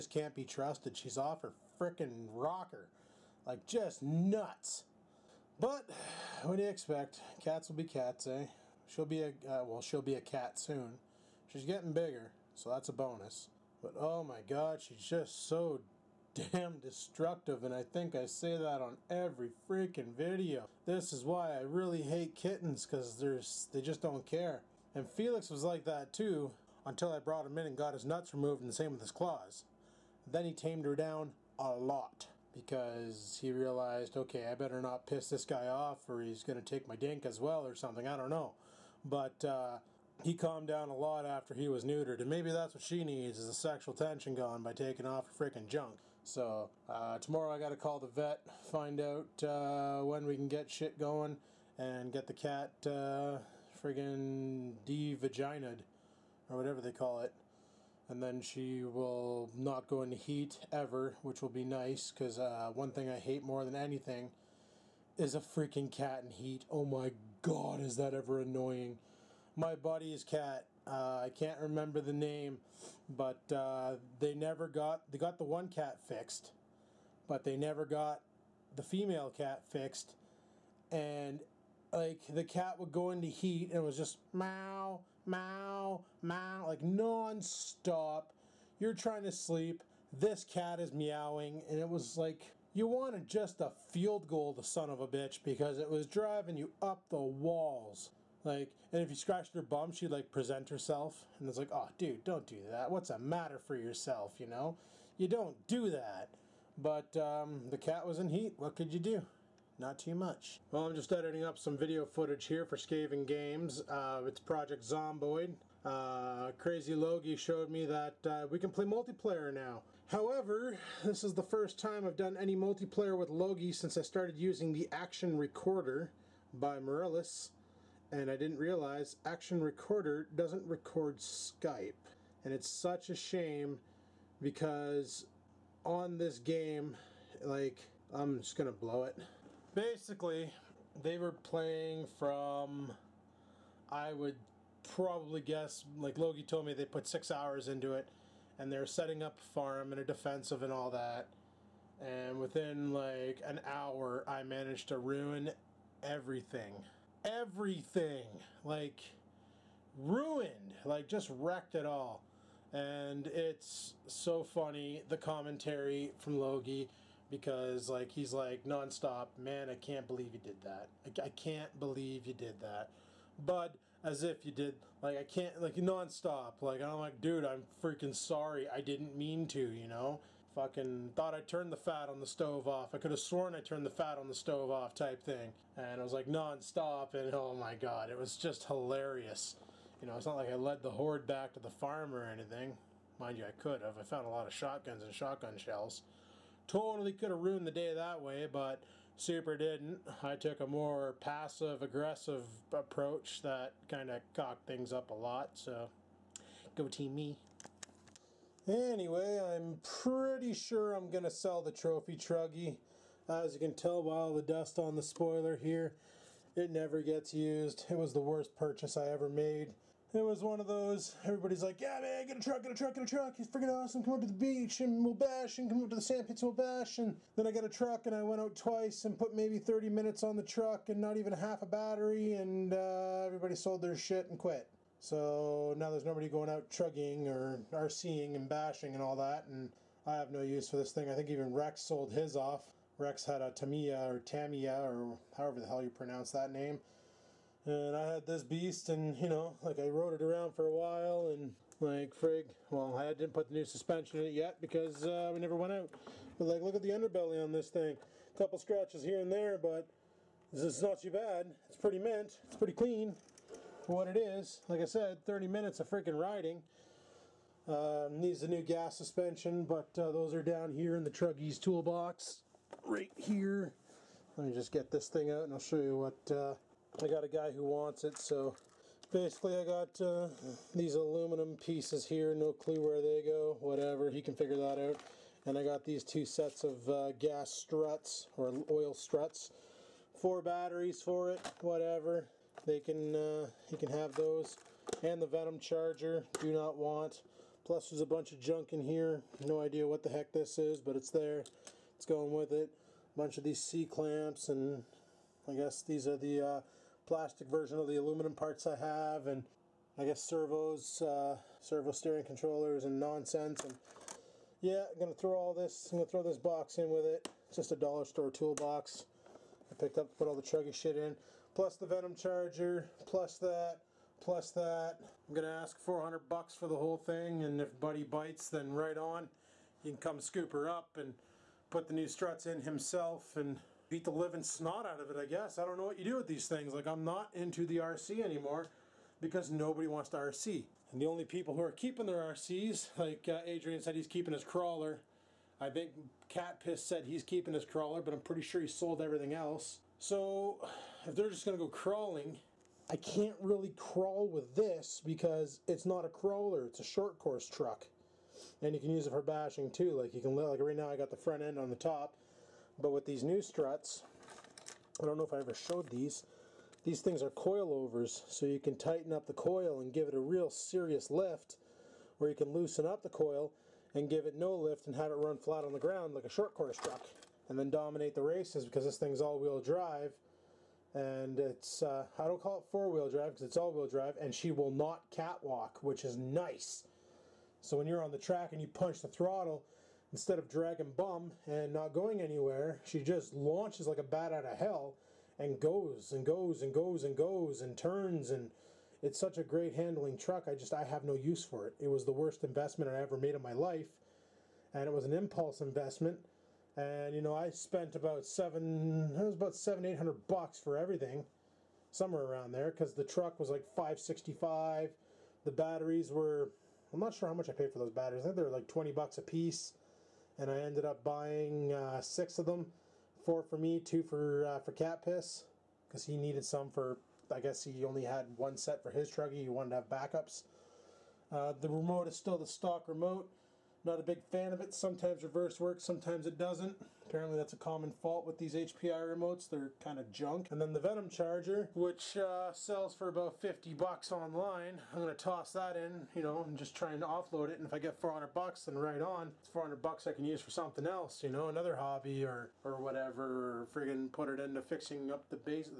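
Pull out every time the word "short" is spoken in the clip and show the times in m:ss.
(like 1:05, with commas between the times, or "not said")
5:56, 6:16.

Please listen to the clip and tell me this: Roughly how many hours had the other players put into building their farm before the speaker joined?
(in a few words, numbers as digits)
6 hours.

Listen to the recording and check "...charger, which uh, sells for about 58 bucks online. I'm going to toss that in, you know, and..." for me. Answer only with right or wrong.
wrong.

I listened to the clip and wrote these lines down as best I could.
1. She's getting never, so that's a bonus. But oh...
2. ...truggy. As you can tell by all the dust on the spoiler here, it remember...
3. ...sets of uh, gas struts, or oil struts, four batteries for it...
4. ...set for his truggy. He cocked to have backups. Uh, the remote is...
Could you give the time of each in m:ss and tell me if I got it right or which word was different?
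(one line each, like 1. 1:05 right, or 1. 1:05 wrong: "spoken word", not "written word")
1. 0:11 wrong: "bigger", not "never"
2. 3:32 wrong: "never", not "remember"
3. 4:46 right
4. 7:08 wrong: "wanted", not "cocked".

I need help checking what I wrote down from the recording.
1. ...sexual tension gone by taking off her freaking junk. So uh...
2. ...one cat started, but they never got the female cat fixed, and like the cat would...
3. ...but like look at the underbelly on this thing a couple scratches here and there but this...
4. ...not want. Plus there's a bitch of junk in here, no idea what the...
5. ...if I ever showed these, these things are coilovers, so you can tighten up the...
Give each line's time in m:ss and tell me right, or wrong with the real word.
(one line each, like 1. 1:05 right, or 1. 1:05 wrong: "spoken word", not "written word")
1. 0:43 right
2. 1:15 wrong: "fixed", not "started"
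3. 4:16 right
4. 4:56 wrong: "bunch", not "bitch"
5. 6:05 right.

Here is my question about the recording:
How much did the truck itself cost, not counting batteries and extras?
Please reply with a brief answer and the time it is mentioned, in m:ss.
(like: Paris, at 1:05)
565, at 6:53.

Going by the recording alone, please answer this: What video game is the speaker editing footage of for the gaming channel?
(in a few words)
Project Zomboid.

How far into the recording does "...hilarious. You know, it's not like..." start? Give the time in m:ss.
3:08.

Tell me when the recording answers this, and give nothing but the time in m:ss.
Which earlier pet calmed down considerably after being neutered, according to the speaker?
0:25.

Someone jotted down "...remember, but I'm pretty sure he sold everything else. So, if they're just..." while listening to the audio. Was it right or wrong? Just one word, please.
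wrong.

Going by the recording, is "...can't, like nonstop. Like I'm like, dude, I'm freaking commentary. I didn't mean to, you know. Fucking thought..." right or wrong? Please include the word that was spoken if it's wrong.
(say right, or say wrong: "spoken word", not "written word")
wrong: "sorry", not "commentary".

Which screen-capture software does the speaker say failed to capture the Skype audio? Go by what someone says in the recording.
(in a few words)
Action Recorder by Mirillis.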